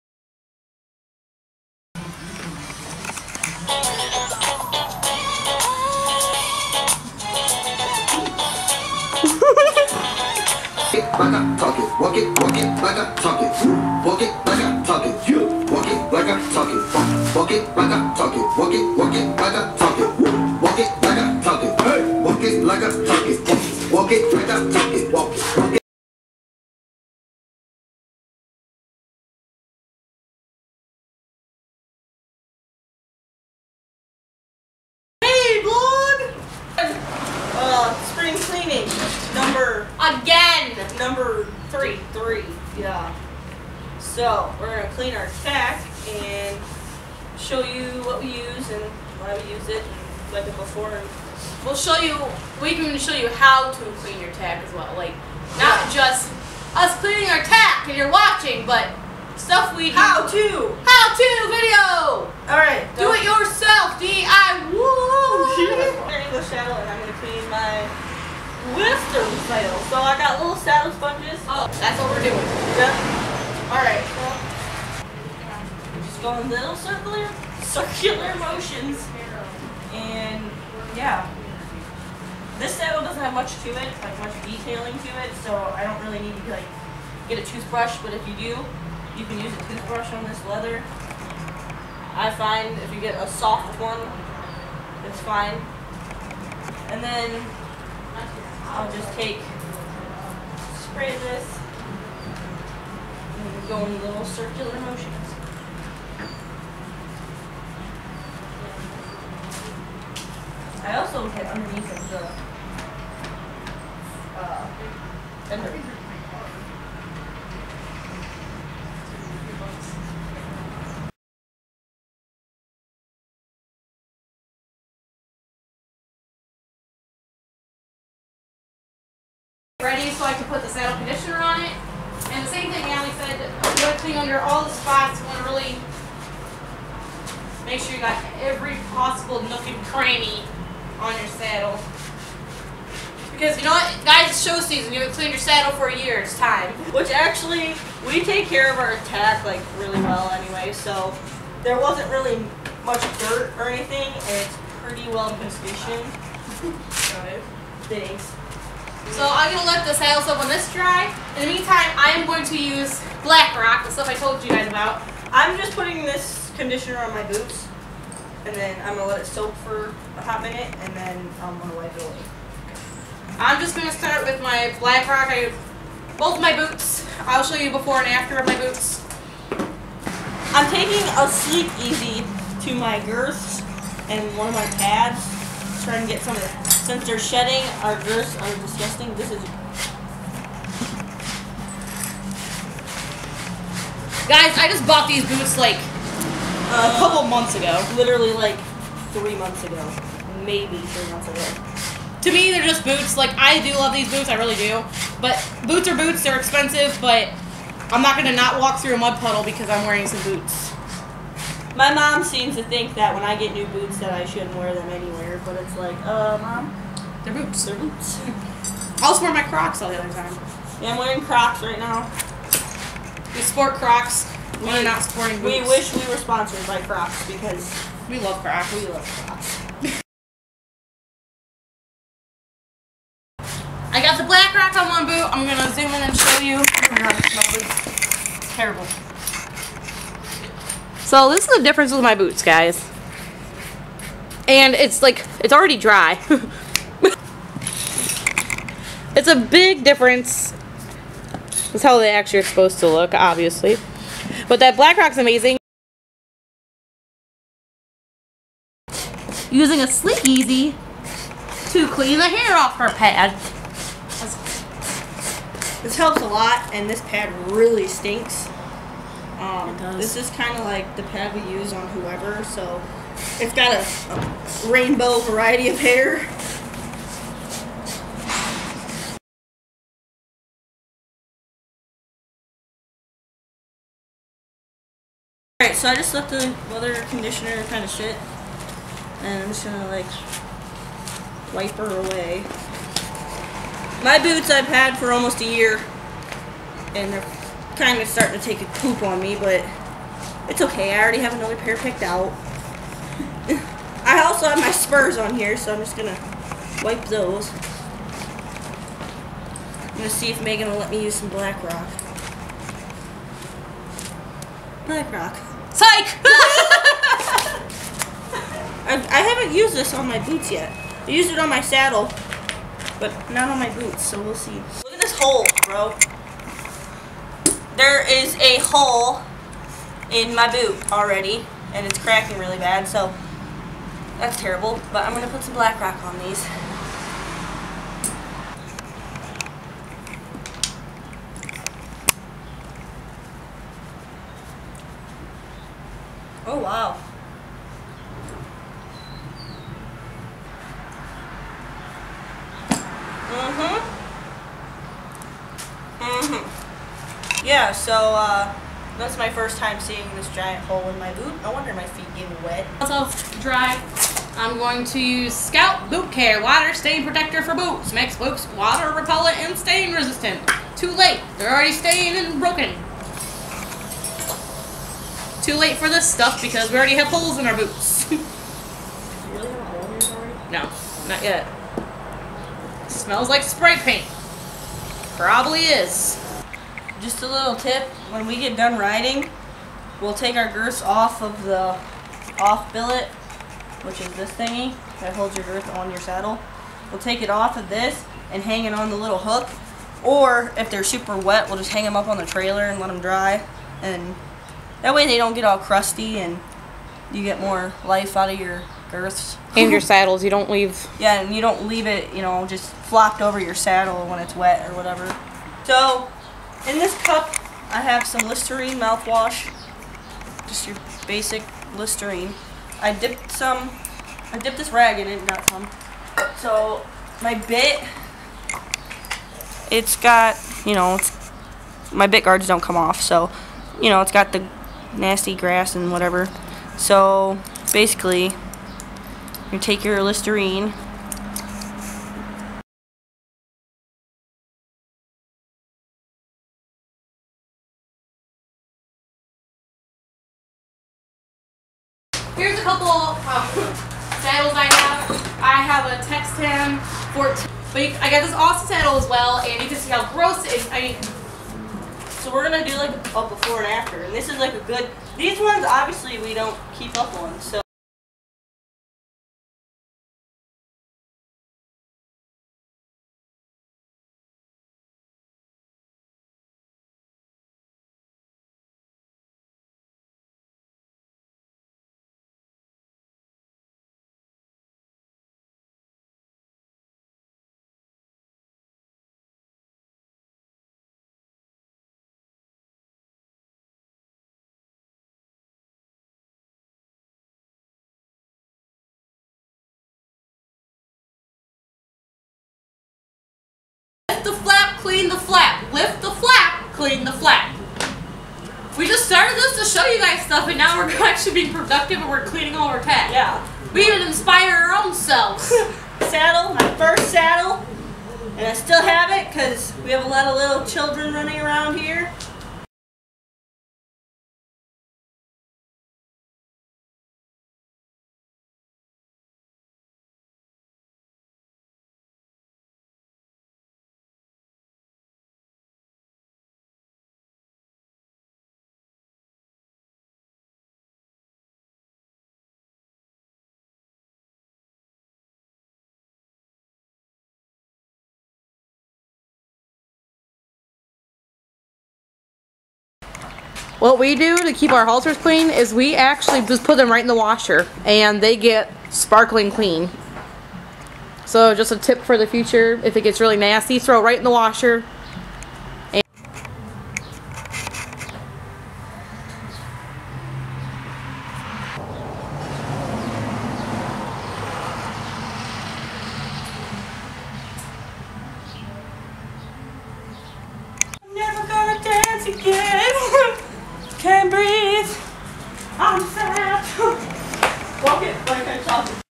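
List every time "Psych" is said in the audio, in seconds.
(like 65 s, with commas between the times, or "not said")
315 s.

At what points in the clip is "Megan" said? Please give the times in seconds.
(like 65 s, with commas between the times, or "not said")
310 s.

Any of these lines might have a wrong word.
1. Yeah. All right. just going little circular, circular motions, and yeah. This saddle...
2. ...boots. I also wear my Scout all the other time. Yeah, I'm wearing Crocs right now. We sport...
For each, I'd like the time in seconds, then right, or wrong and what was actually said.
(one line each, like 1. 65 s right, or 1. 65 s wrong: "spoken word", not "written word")
1. 72 s right
2. 217 s wrong: "Crocs", not "Scout".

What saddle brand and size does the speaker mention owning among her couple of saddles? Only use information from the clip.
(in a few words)
Textan 14.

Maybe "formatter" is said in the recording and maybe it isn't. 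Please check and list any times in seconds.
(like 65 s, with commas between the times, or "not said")
not said.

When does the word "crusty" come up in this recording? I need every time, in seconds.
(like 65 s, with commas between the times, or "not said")
405 s.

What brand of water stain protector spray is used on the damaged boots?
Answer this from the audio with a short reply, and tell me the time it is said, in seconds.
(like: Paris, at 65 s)
Scout, at 365 s.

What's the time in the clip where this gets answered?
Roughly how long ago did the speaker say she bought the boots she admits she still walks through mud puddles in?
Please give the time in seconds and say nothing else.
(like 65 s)
197 s.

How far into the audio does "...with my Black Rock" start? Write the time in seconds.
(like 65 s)
174 s.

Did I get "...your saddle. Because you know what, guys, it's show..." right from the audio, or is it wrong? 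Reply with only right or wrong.
right.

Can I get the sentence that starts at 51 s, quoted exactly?
We'll show you, we can show you how to clean your tack as well.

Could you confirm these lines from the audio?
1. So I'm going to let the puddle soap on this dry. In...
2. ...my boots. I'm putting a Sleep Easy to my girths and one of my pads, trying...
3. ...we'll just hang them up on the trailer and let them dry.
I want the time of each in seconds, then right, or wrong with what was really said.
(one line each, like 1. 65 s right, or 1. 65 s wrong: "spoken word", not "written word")
1. 159 s wrong: "saddle", not "puddle"
2. 178 s wrong: "taking", not "putting"
3. 401 s right.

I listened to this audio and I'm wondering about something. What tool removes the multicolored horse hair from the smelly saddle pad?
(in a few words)
SleekEZ.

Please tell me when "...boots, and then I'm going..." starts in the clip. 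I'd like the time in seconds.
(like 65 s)
167 s.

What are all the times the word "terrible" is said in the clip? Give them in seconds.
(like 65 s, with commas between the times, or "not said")
238 s, 334 s.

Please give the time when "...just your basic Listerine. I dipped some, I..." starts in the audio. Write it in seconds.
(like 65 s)
420 s.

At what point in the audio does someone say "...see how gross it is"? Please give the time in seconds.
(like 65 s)
459 s.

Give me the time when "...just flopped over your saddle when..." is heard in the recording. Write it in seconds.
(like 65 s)
412 s.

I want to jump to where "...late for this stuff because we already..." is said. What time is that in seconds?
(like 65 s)
375 s.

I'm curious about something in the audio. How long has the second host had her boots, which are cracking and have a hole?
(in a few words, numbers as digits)
Almost a year.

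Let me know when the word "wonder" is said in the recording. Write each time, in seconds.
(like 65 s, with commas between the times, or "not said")
361 s.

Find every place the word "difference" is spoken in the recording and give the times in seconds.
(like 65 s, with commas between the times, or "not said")
241 s, 249 s.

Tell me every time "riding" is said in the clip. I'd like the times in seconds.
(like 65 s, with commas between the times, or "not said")
388 s.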